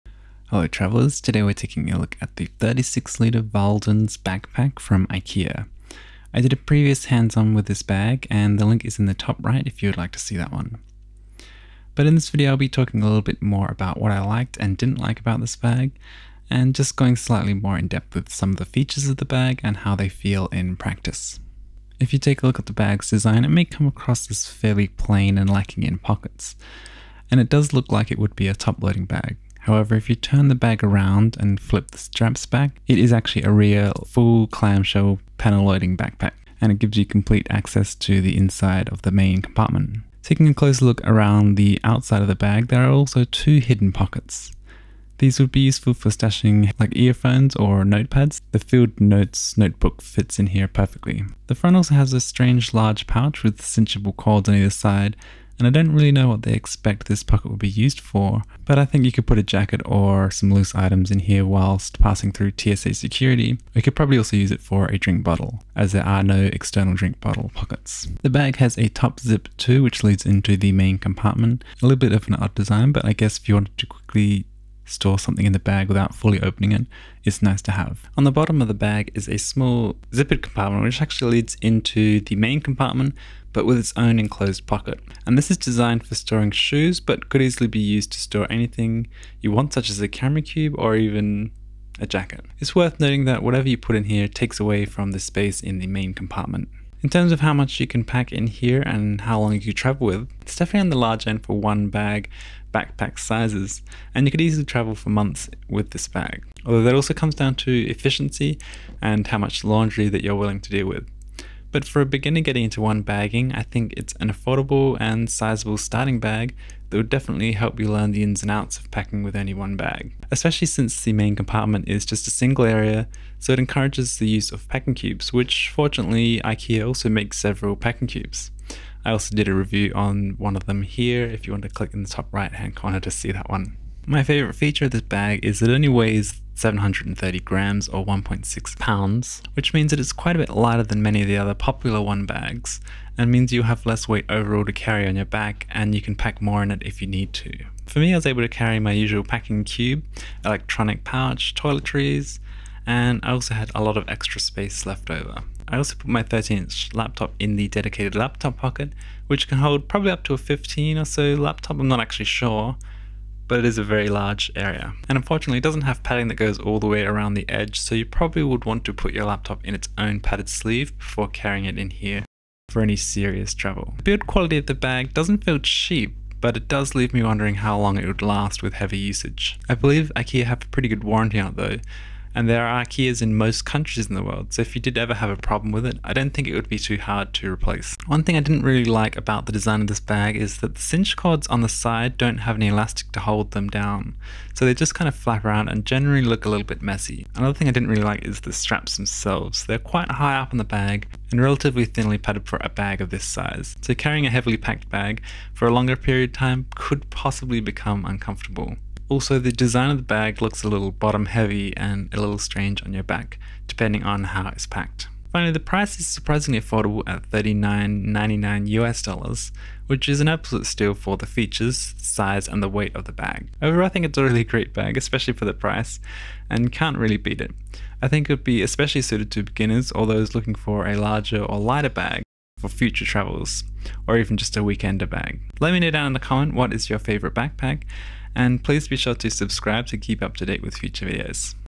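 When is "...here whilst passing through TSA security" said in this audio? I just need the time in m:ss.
1:01.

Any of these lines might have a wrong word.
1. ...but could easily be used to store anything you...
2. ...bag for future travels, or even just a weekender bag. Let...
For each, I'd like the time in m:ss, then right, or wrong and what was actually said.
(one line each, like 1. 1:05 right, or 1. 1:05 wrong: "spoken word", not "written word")
1. 1:26 right
2. 3:51 right.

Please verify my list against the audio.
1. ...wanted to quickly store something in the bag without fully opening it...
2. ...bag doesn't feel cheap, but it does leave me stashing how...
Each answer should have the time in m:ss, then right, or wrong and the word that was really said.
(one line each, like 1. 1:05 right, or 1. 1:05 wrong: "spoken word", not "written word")
1. 1:13 right
2. 2:54 wrong: "wondering", not "stashing".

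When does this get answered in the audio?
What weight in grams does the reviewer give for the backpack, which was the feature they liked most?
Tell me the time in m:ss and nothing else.
2:16.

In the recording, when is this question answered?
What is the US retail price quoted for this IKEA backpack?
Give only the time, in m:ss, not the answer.
3:37.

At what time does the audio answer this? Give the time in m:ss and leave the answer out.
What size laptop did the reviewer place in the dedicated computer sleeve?
2:36.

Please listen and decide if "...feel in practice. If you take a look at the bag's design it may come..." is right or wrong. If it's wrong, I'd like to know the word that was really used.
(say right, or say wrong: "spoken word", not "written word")
right.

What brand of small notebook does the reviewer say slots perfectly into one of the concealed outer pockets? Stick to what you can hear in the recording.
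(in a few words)
Field Notes.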